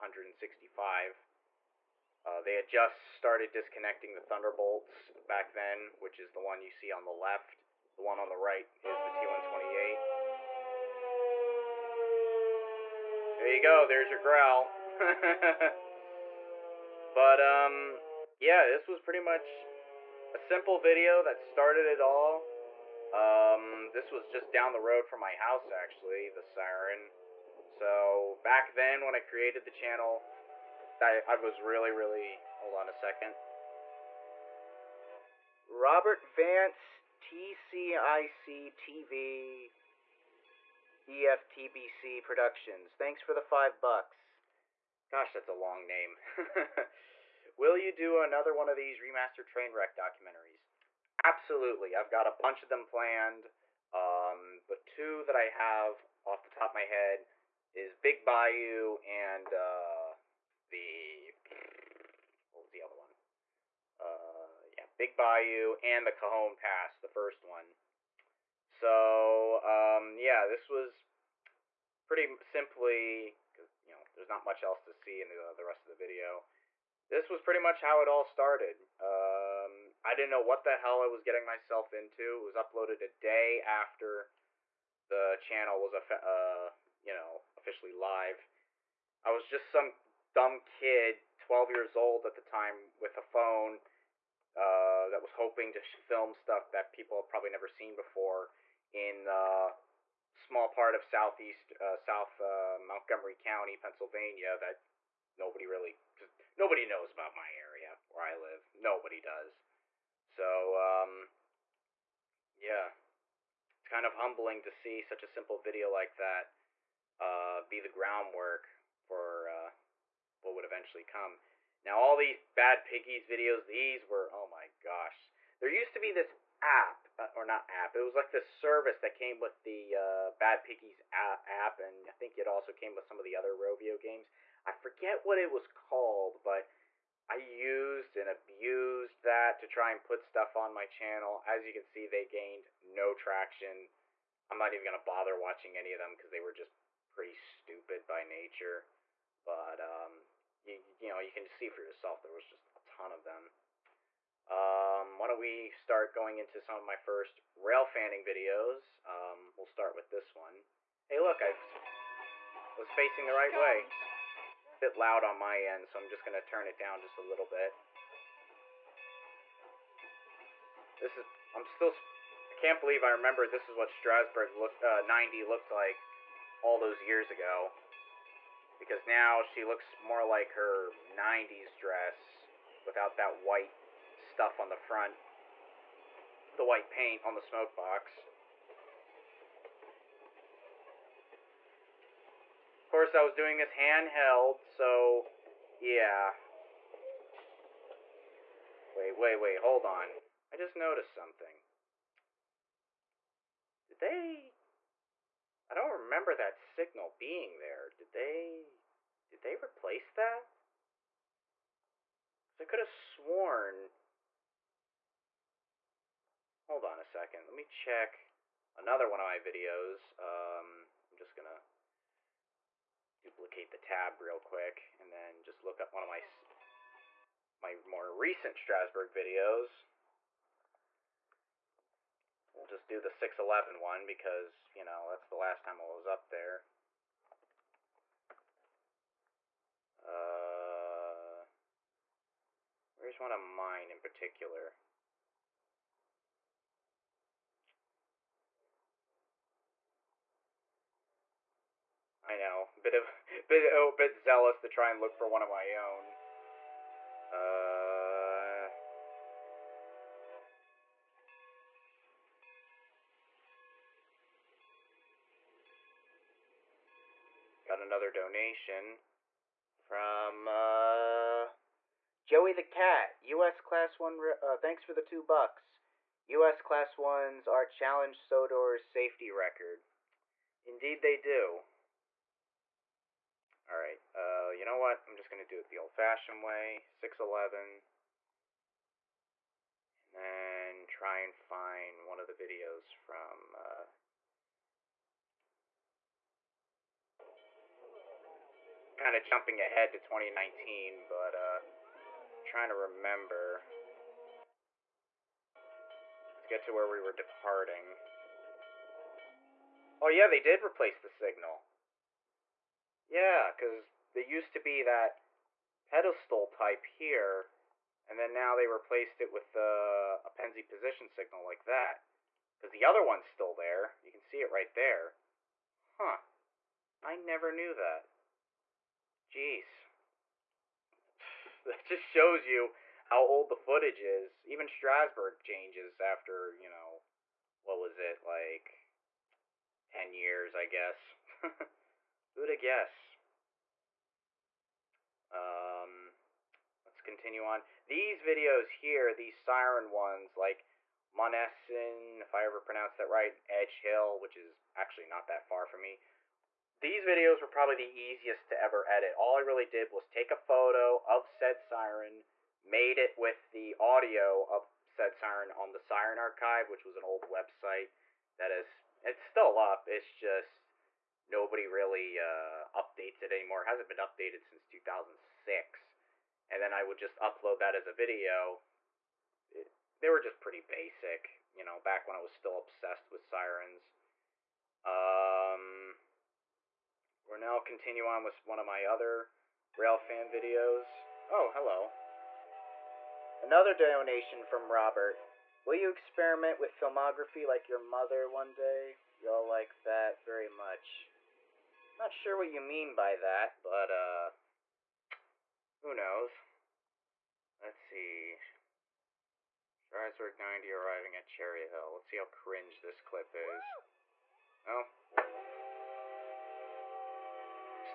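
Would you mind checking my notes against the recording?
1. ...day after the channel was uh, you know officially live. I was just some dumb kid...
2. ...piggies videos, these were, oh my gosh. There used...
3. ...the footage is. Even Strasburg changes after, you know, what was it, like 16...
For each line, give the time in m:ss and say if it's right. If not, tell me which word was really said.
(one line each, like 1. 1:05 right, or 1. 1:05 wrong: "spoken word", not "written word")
1. 1:23 right
2. 2:02 right
3. 5:33 wrong: "10", not "16".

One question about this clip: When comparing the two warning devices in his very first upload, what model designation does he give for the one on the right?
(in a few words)
T128.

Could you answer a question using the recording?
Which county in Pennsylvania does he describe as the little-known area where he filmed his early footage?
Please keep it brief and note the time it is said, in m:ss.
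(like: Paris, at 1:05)
Montgomery County, at 1:42.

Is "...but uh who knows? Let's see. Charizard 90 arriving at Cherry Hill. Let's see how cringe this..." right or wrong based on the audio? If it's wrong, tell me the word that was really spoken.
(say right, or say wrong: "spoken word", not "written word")
right.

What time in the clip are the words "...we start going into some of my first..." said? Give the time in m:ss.
2:35.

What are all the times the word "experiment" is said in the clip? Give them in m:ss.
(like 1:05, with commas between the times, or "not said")
6:35.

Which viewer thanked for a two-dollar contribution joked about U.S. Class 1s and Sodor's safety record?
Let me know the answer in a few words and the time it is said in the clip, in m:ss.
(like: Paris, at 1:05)
Joey the Cat, at 4:32.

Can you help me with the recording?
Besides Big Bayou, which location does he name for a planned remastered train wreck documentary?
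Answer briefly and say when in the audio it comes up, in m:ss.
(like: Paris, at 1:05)
Cajon Pass, at 1:06.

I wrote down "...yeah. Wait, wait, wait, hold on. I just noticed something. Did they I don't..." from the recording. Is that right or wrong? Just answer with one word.
right.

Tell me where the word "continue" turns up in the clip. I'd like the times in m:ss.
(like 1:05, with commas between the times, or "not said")
5:47, 6:27.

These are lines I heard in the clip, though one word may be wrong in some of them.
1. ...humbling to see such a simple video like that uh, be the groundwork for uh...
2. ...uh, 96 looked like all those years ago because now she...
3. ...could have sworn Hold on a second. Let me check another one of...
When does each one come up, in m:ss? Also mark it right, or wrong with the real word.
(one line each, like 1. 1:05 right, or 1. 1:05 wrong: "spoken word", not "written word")
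1. 1:54 right
2. 2:54 wrong: "90", not "96"
3. 3:32 right.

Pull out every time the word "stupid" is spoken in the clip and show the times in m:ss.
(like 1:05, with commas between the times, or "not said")
2:27.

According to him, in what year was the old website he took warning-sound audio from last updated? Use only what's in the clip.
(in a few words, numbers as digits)
2006.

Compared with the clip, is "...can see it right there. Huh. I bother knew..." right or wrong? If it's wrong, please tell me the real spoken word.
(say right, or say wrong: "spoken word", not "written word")
wrong: "never", not "bother".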